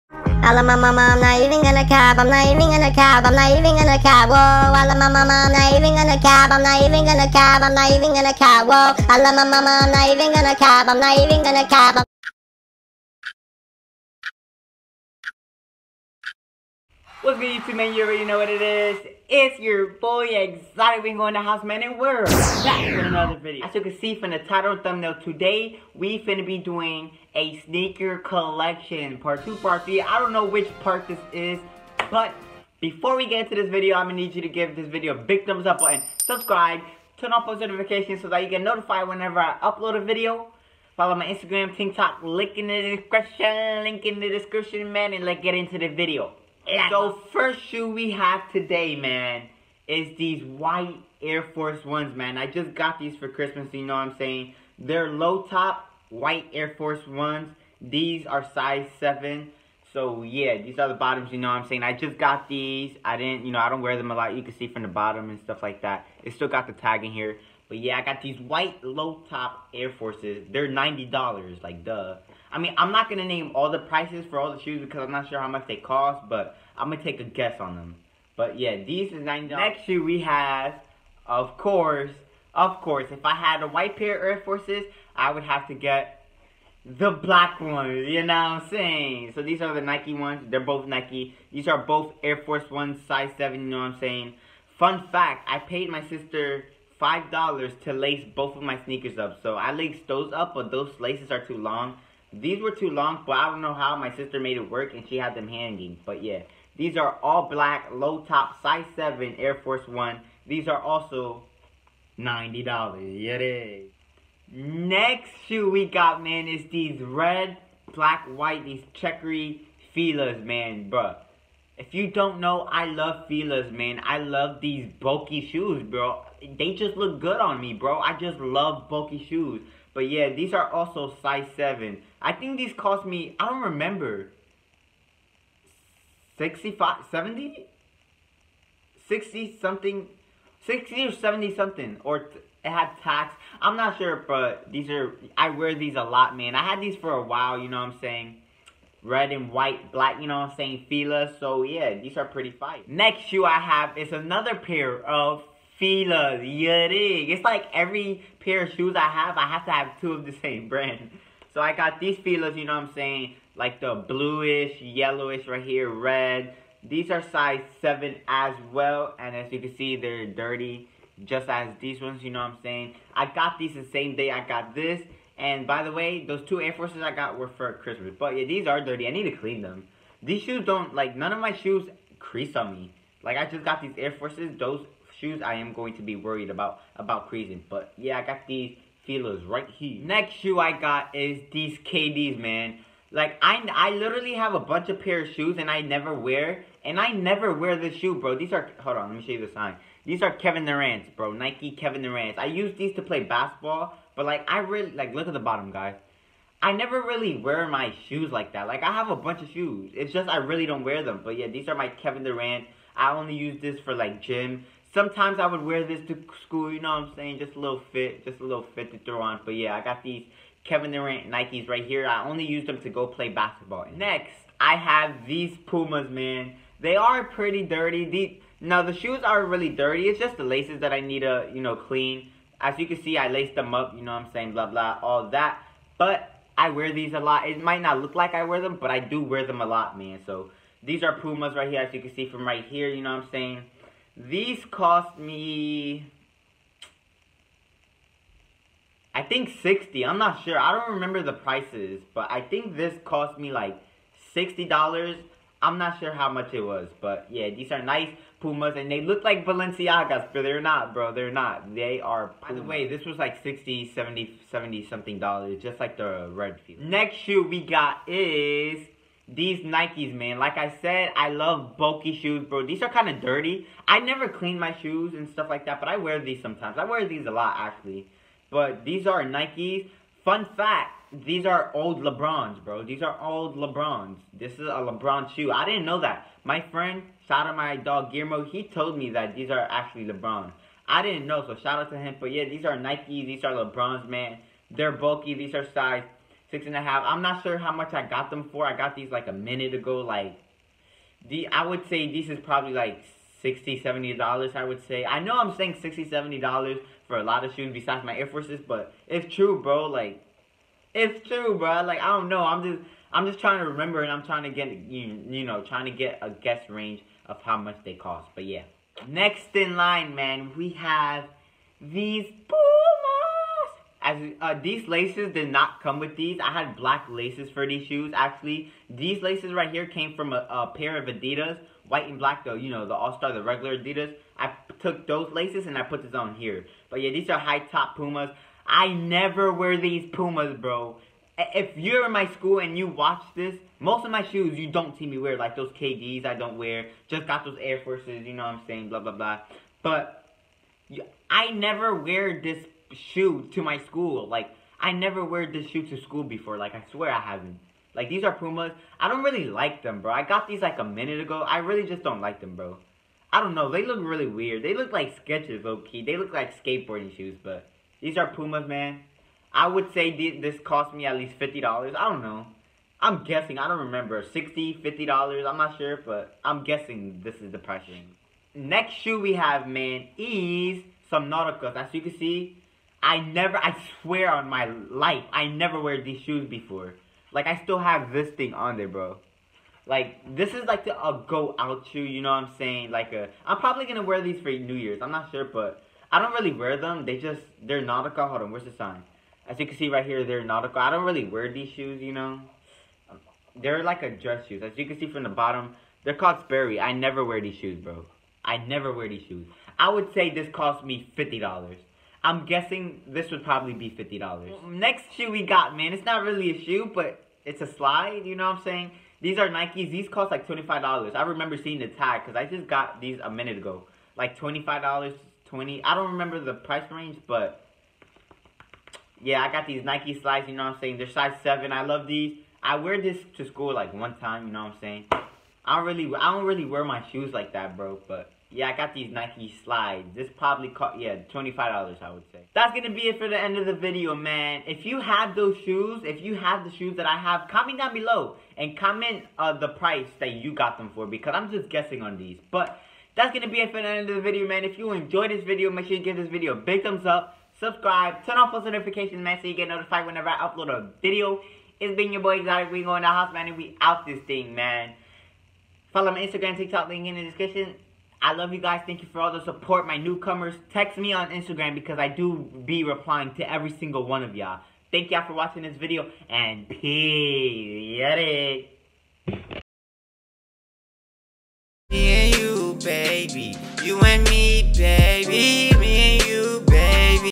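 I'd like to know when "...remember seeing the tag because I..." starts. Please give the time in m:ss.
7:01.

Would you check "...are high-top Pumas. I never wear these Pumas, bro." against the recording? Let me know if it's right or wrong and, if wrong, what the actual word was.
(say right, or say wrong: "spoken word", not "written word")
right.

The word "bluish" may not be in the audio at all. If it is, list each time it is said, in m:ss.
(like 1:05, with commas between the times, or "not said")
2:44.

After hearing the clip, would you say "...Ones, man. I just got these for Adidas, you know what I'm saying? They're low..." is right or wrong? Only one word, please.
wrong.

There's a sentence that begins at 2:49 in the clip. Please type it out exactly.
And as you can see, they're dirty just as these ones, you know what I'm saying?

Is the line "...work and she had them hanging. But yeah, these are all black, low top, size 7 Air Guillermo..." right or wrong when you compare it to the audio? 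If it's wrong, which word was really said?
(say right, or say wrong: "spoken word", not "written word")
wrong: "Force", not "Guillermo".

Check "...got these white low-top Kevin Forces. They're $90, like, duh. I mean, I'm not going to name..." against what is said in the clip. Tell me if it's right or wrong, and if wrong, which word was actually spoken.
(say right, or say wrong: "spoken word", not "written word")
wrong: "Air", not "Kevin".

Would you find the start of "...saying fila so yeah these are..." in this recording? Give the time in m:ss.
2:30.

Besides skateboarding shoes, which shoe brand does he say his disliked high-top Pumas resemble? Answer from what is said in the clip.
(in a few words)
Skechers.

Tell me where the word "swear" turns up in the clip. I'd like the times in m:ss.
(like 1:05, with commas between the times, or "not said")
5:56, 6:24.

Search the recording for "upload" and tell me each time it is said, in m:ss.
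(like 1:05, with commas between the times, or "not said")
0:39, 7:40.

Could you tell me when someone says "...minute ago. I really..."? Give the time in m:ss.
6:00.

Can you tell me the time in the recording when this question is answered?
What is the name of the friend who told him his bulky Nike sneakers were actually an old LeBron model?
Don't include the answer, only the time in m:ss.
4:48.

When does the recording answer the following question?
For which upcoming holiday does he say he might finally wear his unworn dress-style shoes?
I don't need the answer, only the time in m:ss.
6:34.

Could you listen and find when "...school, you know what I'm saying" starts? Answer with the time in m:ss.
3:36.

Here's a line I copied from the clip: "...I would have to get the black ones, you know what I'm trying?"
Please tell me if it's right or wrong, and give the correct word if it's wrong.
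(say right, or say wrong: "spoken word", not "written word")
wrong: "saying", not "trying".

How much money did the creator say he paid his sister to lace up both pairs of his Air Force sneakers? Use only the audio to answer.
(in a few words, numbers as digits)
$5.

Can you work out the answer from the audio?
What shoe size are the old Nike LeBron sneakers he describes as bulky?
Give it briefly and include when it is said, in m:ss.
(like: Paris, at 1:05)
6.5, at 4:55.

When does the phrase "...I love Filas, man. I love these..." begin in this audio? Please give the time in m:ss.
2:02.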